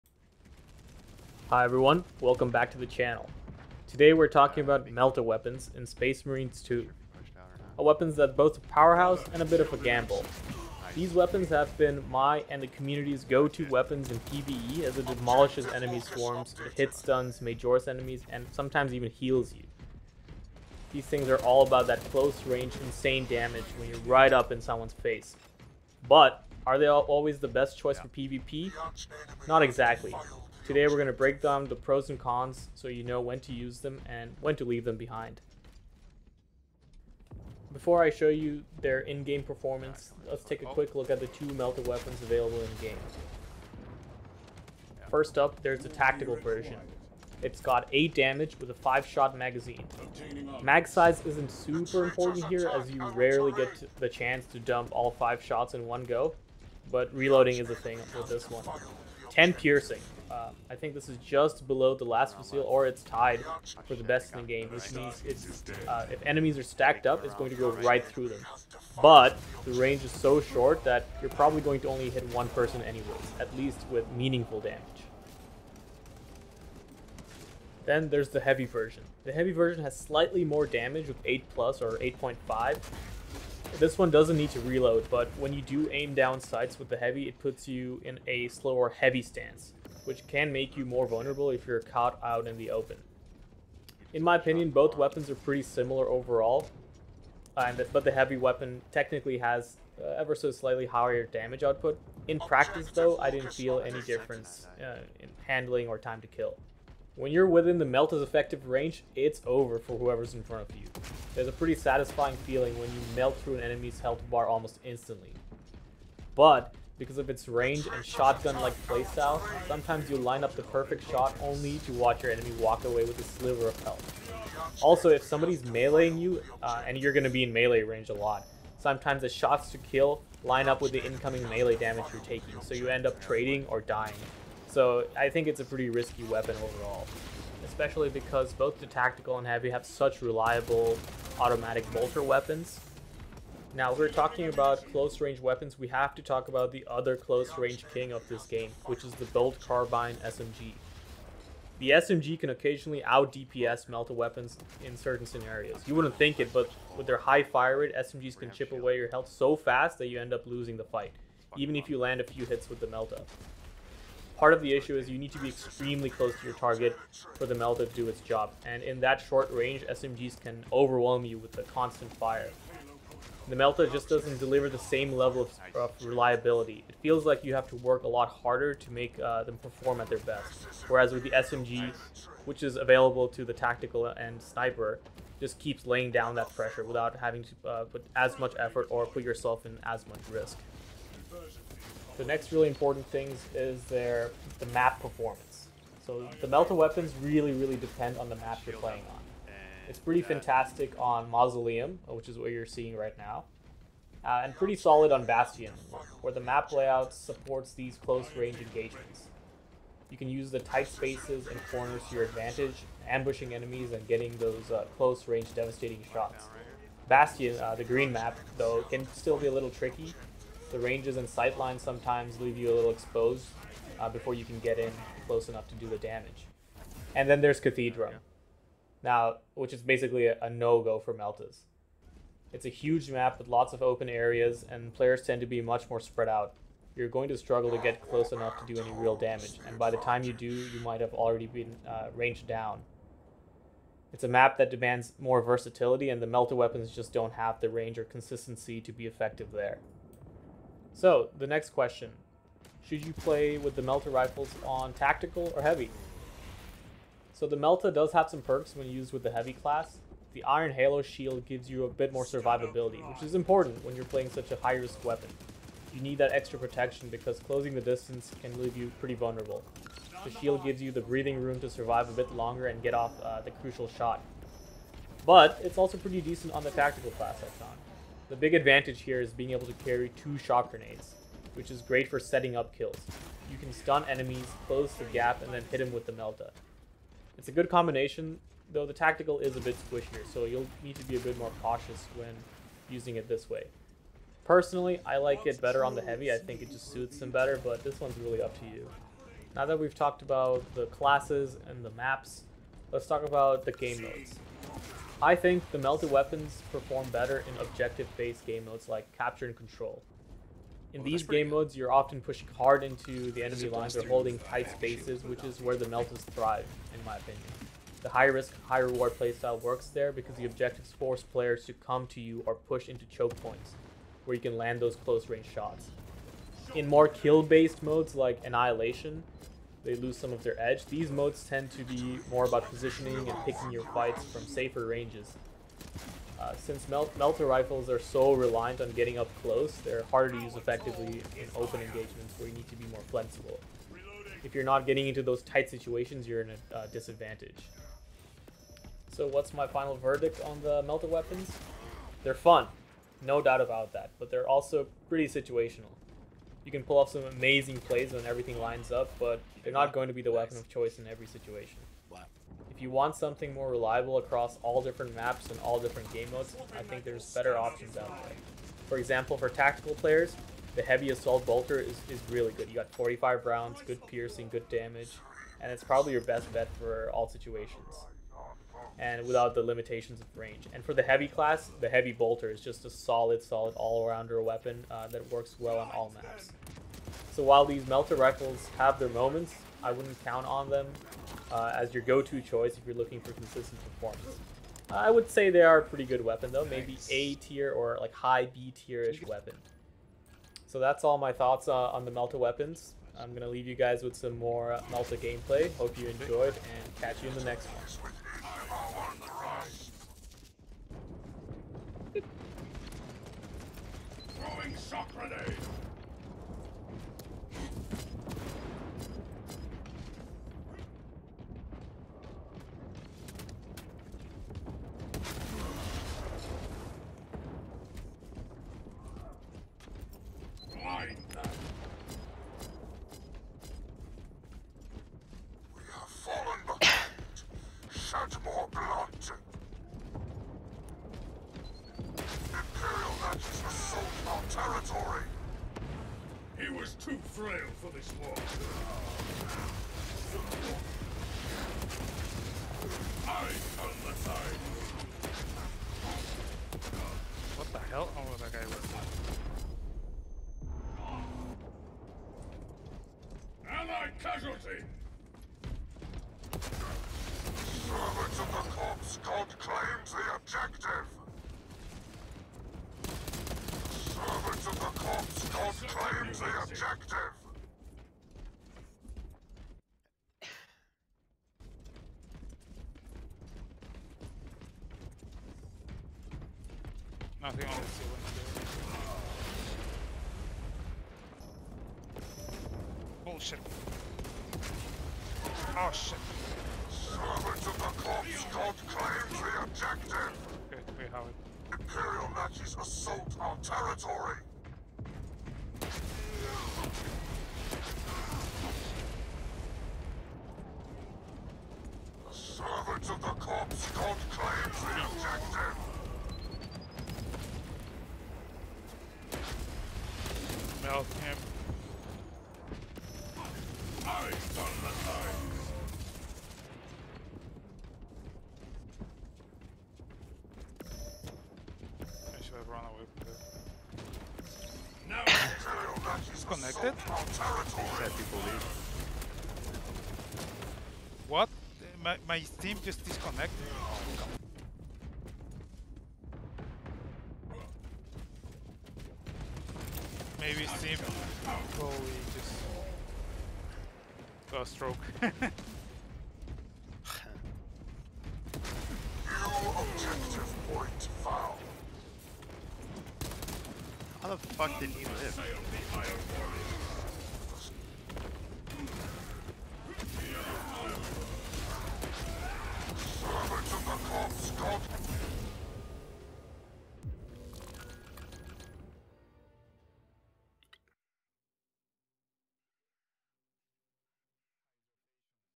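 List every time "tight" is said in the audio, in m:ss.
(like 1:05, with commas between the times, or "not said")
3:30, 5:14, 5:45.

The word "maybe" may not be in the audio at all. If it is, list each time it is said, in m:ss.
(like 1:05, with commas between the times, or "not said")
6:36, 9:10.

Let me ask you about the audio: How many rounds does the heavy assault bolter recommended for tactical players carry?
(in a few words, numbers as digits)
45.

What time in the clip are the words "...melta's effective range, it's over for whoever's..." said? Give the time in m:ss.
1:47.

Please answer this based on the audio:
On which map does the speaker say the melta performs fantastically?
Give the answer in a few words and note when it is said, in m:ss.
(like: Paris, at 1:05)
Mausoleum, at 3:21.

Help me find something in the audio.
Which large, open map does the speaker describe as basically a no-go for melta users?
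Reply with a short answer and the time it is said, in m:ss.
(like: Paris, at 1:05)
Cathedra, at 3:47.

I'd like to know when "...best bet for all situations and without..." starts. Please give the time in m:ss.
6:16.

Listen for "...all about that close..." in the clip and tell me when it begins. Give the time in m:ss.
0:21.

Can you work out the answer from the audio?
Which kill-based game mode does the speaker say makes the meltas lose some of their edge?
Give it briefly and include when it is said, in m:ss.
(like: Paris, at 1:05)
Annihilation, at 5:28.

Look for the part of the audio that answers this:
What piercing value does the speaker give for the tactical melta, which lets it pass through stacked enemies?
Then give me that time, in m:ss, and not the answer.
0:59.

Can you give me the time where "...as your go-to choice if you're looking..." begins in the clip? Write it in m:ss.
6:31.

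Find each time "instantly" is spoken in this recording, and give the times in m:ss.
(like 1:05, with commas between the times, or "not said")
1:54.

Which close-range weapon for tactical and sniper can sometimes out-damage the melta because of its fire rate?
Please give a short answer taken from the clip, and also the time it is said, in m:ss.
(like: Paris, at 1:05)
bolt carbine SMG, at 2:29.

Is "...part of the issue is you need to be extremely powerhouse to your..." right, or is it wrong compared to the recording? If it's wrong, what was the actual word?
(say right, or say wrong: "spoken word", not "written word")
wrong: "close", not "powerhouse".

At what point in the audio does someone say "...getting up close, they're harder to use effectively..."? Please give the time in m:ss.
5:38.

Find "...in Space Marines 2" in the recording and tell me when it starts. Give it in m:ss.
0:05.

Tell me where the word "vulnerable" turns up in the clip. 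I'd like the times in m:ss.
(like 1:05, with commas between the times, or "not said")
1:31, 4:29.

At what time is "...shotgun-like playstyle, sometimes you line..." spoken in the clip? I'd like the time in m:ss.
1:58.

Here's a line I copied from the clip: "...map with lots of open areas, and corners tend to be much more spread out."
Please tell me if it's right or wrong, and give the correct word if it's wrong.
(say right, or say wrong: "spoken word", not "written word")
wrong: "players", not "corners".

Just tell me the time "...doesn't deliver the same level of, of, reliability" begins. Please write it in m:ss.
2:54.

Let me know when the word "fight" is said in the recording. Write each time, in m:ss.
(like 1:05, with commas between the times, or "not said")
2:40, 5:33.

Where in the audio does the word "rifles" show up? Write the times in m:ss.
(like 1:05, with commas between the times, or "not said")
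4:14, 5:37, 6:28.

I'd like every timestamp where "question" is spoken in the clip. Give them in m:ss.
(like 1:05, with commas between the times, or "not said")
4:11.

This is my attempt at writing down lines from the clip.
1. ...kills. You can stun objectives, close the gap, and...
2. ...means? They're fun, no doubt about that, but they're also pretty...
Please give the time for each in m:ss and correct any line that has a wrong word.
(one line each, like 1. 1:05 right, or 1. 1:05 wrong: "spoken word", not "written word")
1. 4:42 wrong: "enemies", not "objectives"
2. 5:51 wrong: "weapons", not "means".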